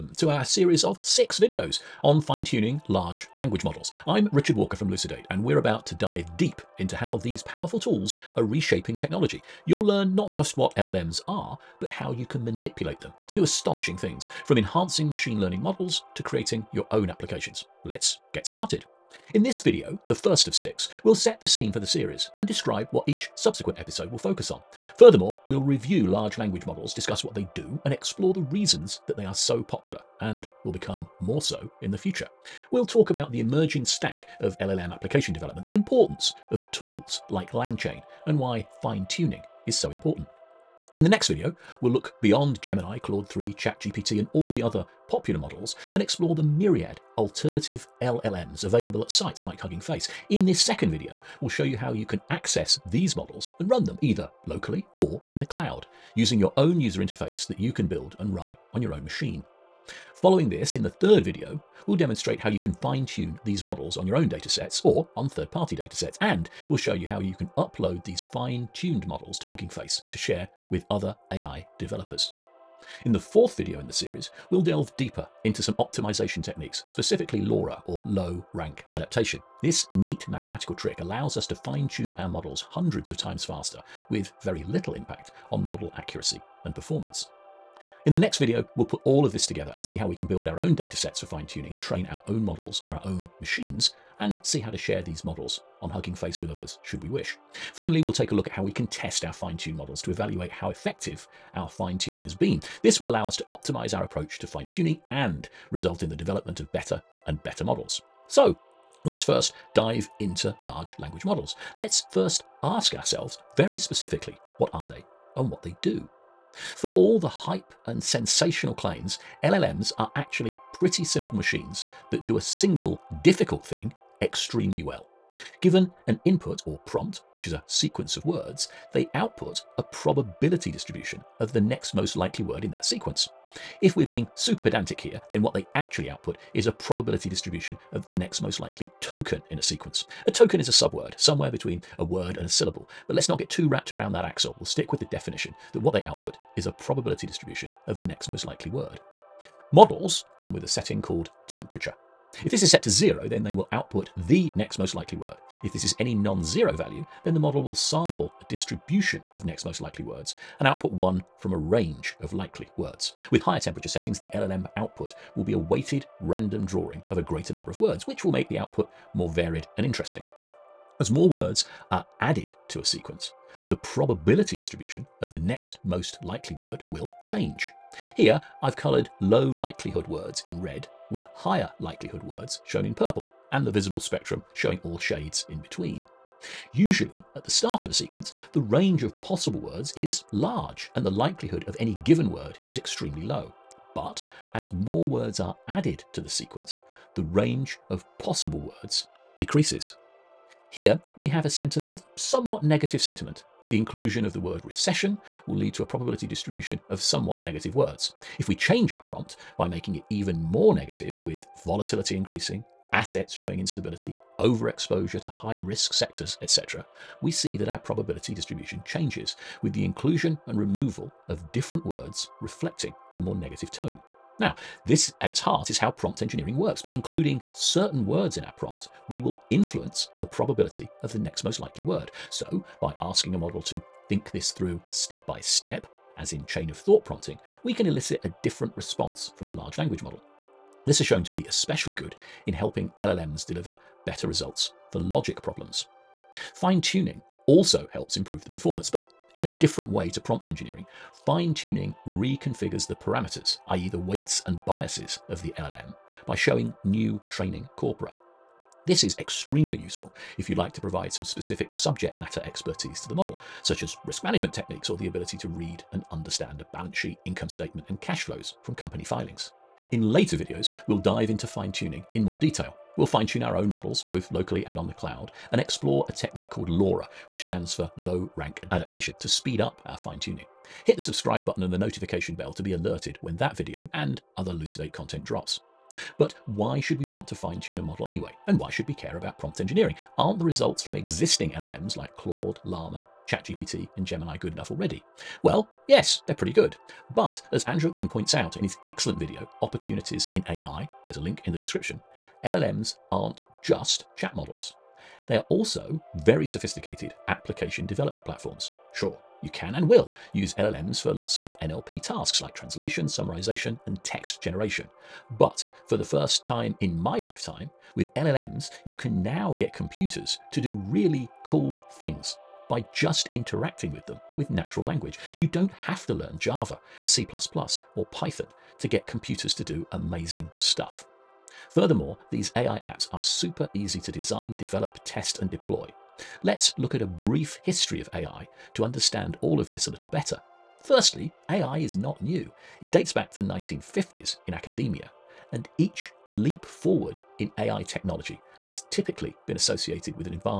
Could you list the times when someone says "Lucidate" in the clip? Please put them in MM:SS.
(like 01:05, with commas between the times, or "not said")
00:04, 04:44.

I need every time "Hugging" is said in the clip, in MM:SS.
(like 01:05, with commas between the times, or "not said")
00:49, 01:09, 01:35.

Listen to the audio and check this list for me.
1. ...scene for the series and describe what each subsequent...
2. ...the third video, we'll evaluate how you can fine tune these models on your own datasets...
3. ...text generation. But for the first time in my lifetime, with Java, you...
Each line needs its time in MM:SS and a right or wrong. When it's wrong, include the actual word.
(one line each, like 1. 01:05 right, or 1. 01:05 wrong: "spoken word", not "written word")
1. 00:21 right
2. 01:00 wrong: "demonstrate", not "evaluate"
3. 05:14 wrong: "LLMs", not "Java".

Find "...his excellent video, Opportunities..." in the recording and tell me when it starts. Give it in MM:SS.
04:58.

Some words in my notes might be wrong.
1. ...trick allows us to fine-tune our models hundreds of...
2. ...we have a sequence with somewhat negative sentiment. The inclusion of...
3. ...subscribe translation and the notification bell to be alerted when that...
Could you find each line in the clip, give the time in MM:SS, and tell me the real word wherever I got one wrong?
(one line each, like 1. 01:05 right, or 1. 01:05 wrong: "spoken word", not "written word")
1. 01:20 right
2. 03:21 wrong: "sentence", not "sequence"
3. 04:41 wrong: "button", not "translation".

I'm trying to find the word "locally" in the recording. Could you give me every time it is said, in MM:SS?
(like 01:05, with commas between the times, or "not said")
00:54, 04:34.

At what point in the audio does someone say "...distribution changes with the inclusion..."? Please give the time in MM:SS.
03:38.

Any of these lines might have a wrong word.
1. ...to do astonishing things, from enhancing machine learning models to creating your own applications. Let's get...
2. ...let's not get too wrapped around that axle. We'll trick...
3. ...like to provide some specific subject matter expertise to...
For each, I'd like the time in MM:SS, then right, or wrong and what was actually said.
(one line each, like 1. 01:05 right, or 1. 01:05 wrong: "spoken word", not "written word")
1. 00:13 right
2. 02:23 wrong: "stick", not "trick"
3. 04:20 right.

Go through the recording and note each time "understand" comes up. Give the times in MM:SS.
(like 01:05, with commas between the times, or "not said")
04:26, 05:38.